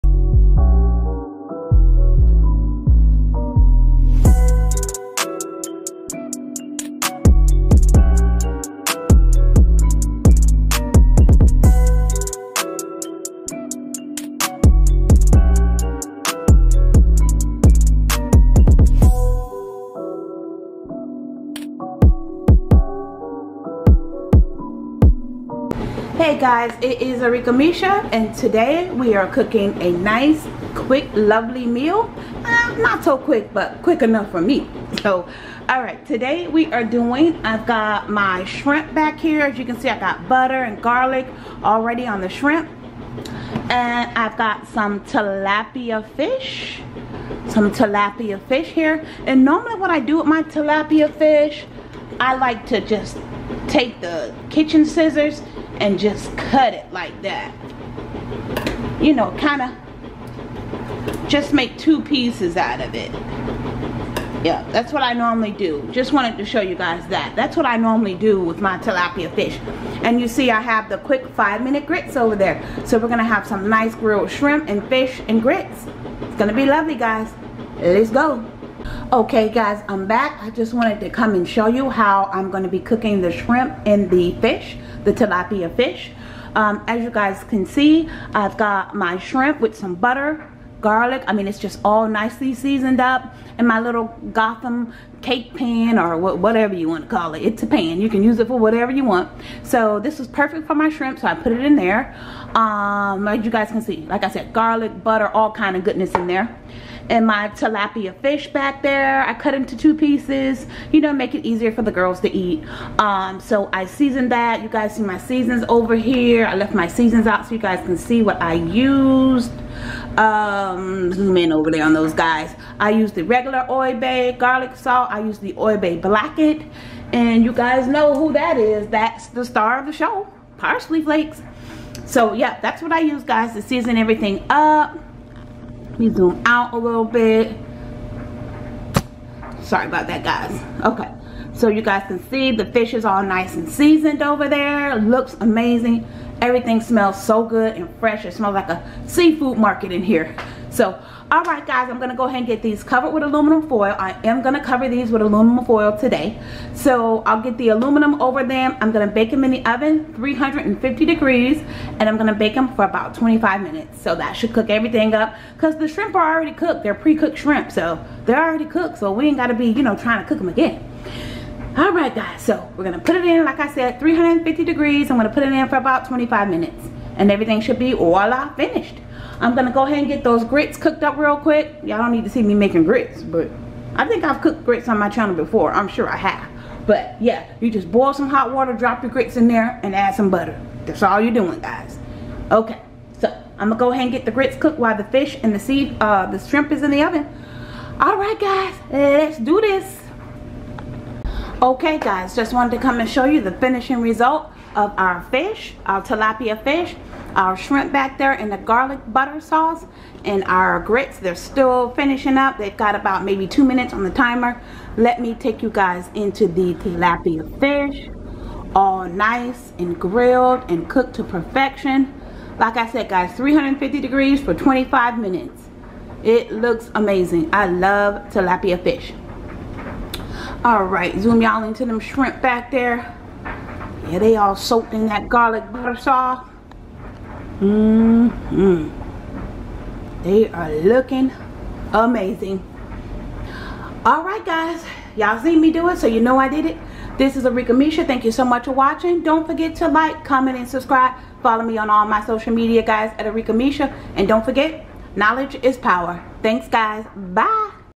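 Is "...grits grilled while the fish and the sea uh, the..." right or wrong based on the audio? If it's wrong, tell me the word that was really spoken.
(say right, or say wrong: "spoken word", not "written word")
wrong: "cooked", not "grilled".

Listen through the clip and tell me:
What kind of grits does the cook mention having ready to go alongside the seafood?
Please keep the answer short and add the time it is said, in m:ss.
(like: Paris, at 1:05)
Quick five minute grits, at 1:10.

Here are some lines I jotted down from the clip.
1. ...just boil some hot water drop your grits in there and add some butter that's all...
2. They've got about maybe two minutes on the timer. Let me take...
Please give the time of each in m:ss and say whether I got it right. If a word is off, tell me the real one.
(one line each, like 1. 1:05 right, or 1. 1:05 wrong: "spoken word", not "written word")
1. 3:07 right
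2. 3:32 right.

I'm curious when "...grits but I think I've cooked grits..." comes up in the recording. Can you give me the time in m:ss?
3:02.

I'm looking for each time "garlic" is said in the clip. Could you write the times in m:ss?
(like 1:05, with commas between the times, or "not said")
0:40, 1:30, 1:44, 2:04, 3:28, 3:55.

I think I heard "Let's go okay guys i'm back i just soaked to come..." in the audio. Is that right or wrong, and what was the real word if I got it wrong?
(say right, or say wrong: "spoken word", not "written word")
wrong: "wanted", not "soaked".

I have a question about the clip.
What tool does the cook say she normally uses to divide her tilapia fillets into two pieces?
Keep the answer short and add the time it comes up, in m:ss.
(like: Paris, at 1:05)
Kitchen scissors, at 0:54.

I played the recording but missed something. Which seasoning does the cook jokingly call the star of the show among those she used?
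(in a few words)
Parsley flakes.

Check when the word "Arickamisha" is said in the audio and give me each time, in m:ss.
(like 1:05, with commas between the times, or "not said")
0:27, 4:07, 4:13.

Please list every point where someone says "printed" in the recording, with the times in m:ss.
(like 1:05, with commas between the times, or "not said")
not said.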